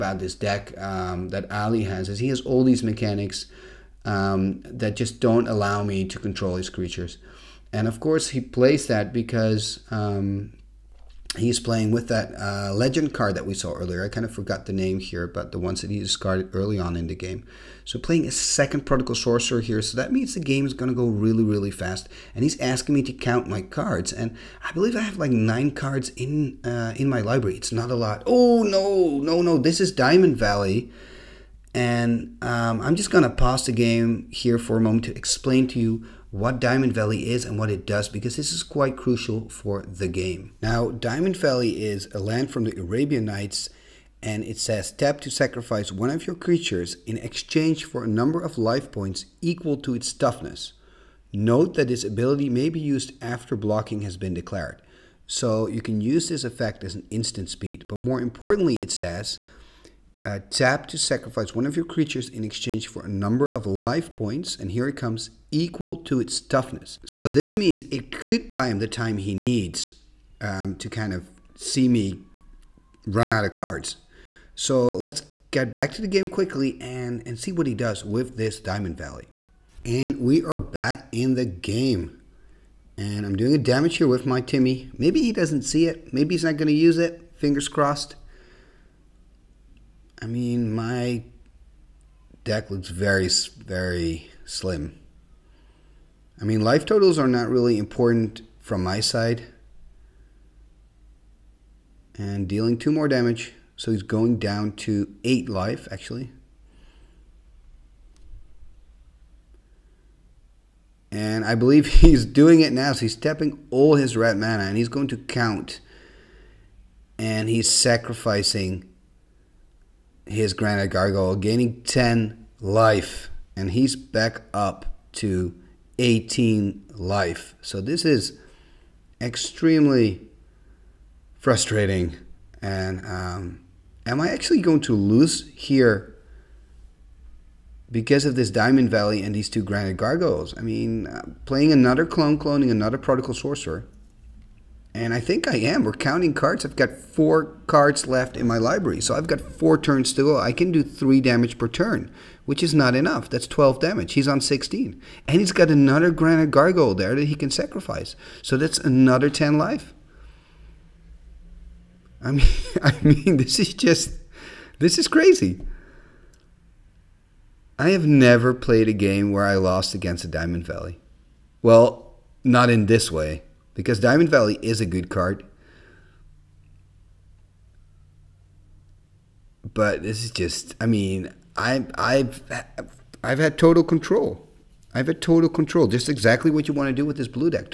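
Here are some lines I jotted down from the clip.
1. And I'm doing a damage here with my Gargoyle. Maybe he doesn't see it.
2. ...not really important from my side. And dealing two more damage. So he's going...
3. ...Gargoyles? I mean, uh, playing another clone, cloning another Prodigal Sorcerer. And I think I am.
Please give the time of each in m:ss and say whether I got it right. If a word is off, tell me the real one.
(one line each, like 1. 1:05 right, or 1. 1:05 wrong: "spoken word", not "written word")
1. 1:22 wrong: "Timmy", not "Gargoyle"
2. 1:37 right
3. 2:19 right.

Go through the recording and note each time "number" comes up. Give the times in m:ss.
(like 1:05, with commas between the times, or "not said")
0:48, 1:03.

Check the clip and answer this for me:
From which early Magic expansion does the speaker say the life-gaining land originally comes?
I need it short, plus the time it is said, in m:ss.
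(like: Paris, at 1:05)
Arabian Nights, at 0:42.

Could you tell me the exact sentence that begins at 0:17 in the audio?
So playing a second prodigal Sorcerer here, so that means the game is going to go really, really fast.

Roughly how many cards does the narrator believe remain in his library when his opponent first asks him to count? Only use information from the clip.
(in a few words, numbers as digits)
9.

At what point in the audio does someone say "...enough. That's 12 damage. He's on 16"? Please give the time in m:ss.
2:32.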